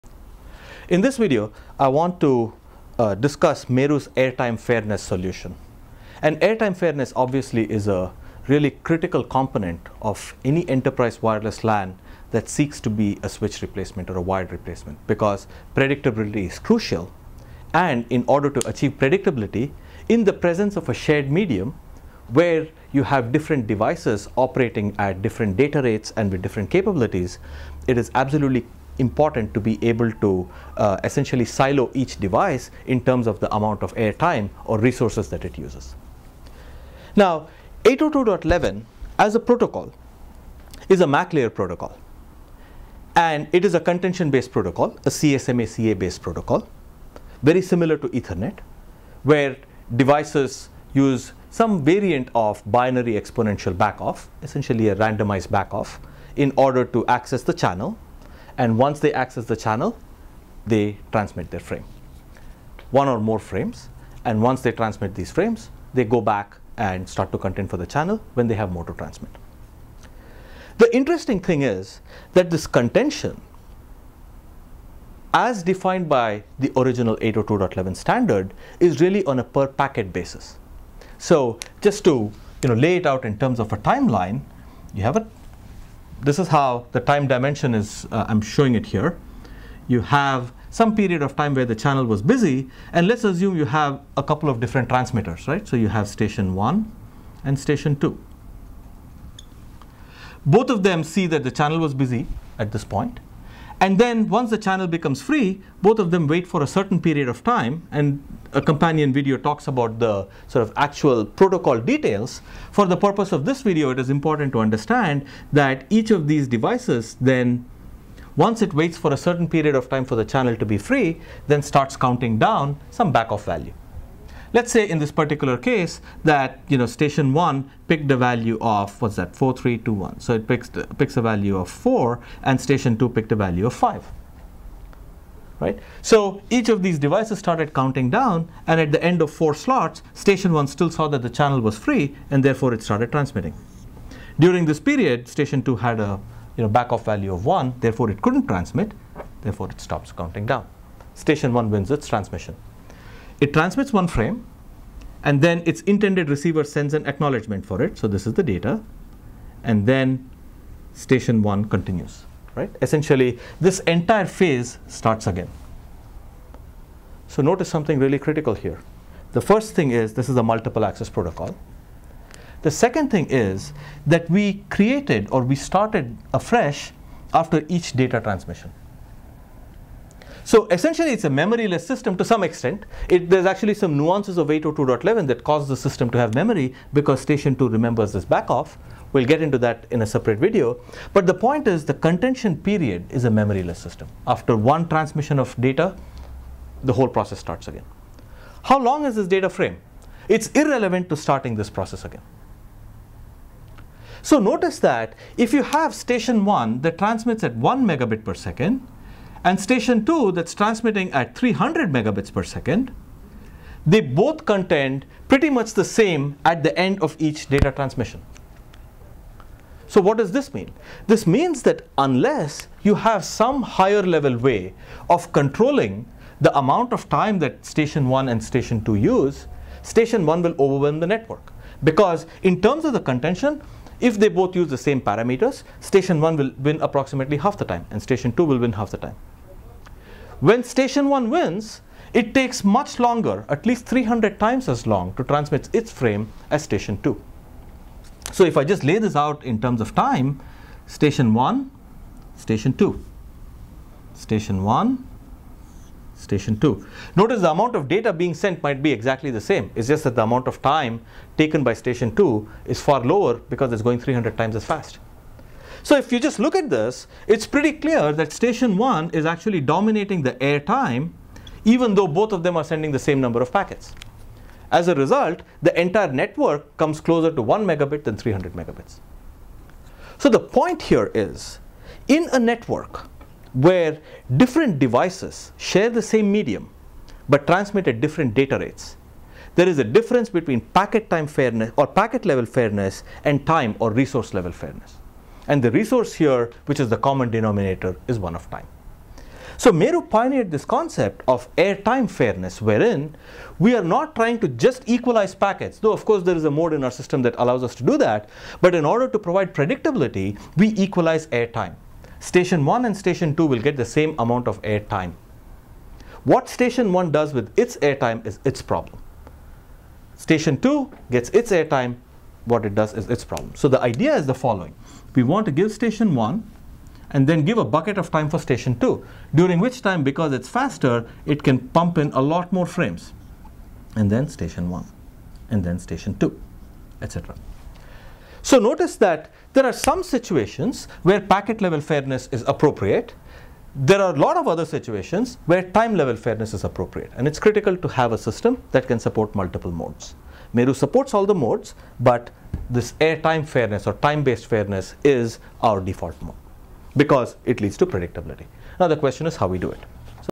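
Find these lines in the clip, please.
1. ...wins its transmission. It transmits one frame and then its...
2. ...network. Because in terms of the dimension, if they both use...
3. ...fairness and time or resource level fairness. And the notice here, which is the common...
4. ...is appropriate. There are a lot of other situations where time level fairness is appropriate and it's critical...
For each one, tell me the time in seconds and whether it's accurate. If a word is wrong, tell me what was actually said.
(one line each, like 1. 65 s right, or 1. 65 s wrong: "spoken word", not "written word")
1. 151 s right
2. 231 s wrong: "contention", not "dimension"
3. 292 s wrong: "resource", not "notice"
4. 342 s right.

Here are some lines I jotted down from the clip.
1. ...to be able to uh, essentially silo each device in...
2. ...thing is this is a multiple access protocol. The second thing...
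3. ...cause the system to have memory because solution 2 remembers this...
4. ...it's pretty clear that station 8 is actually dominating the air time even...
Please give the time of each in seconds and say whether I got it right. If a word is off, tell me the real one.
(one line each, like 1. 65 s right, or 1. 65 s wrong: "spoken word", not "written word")
1. 29 s right
2. 169 s right
3. 185 s wrong: "station", not "solution"
4. 267 s wrong: "1", not "8".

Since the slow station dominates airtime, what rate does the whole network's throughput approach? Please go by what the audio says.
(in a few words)
1 megabit.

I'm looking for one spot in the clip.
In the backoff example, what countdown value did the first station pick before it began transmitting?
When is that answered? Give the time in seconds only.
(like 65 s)
130 s.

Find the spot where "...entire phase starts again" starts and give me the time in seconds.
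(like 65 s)
163 s.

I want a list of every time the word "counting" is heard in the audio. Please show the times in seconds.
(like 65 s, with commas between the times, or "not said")
121 s, 137 s, 150 s.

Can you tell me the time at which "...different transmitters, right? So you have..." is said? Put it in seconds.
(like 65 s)
94 s.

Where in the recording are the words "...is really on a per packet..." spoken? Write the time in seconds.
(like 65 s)
78 s.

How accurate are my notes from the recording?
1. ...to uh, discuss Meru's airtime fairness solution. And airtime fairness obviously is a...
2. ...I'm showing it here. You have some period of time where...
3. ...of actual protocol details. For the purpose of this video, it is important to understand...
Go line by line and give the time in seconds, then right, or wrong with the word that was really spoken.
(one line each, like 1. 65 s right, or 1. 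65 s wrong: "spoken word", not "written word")
1. 2 s right
2. 88 s right
3. 110 s right.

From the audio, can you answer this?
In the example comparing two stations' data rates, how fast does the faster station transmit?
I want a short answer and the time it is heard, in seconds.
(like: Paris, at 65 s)
300 megabits per second, at 211 s.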